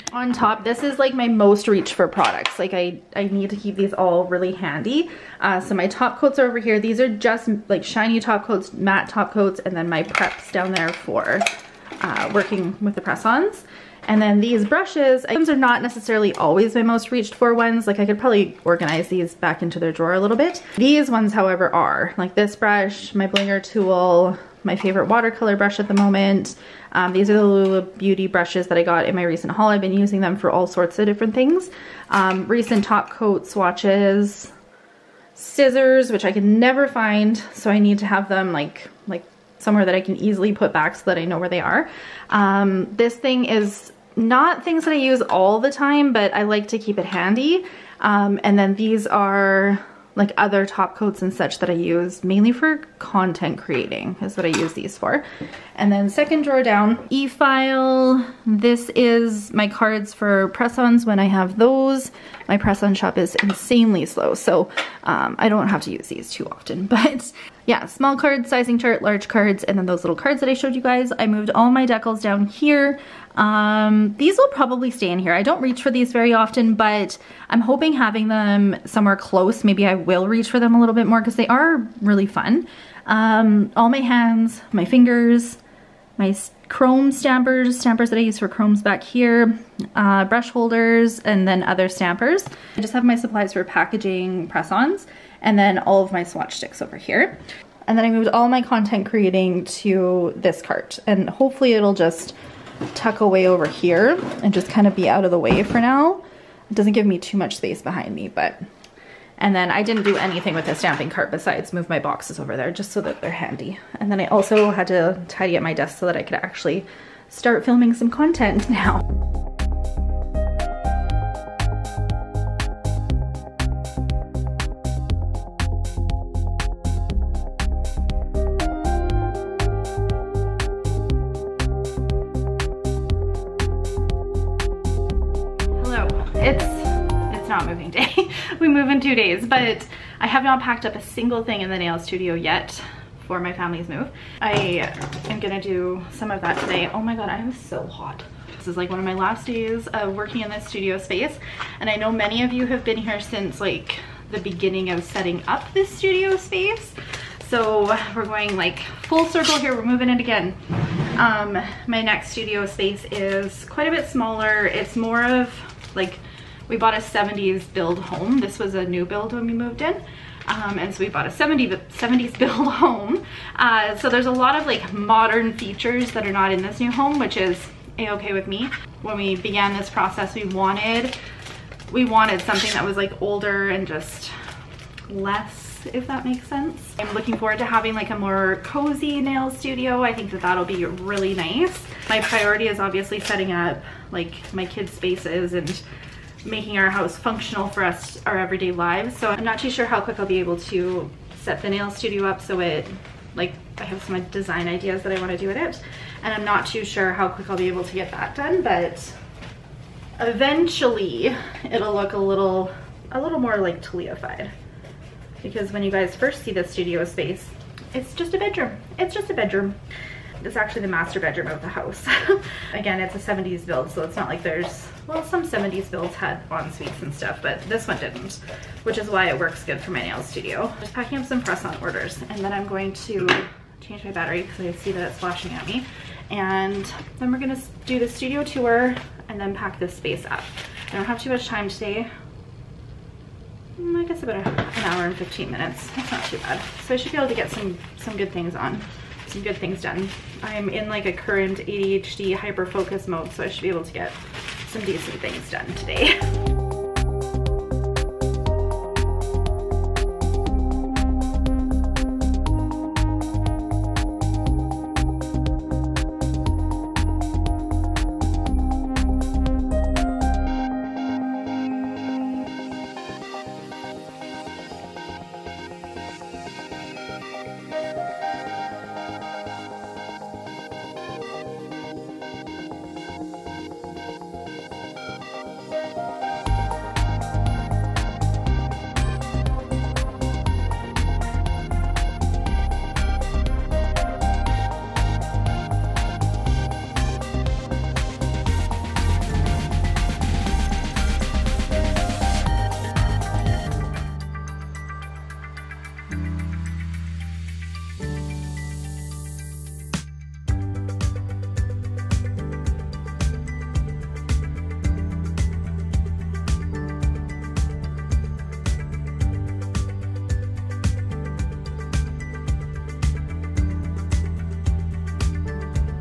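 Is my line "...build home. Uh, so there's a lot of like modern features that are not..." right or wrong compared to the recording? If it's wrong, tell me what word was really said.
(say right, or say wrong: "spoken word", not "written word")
right.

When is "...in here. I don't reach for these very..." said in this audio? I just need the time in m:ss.
1:15.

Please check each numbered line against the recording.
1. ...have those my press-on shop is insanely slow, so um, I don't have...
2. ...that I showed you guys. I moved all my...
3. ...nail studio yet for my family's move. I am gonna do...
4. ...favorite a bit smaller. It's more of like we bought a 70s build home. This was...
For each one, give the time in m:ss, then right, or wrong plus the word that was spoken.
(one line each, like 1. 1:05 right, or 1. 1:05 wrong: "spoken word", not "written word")
1. 1:01 right
2. 1:10 right
3. 2:21 right
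4. 2:43 wrong: "quite", not "favorite".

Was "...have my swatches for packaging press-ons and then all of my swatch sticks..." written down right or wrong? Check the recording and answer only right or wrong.
wrong.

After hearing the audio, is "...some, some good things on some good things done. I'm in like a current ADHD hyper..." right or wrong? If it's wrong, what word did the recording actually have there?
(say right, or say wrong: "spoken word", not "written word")
right.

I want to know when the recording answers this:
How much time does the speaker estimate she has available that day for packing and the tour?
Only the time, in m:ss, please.
4:04.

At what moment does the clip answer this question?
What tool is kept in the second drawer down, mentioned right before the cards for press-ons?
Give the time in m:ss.
0:57.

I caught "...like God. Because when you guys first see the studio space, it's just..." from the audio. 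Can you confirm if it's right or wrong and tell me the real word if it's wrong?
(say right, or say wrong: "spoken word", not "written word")
wrong: "Taliafied", not "God".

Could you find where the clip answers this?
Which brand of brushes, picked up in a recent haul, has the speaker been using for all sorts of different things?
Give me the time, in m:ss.
0:27.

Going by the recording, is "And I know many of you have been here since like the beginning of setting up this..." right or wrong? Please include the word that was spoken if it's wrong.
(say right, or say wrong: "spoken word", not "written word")
right.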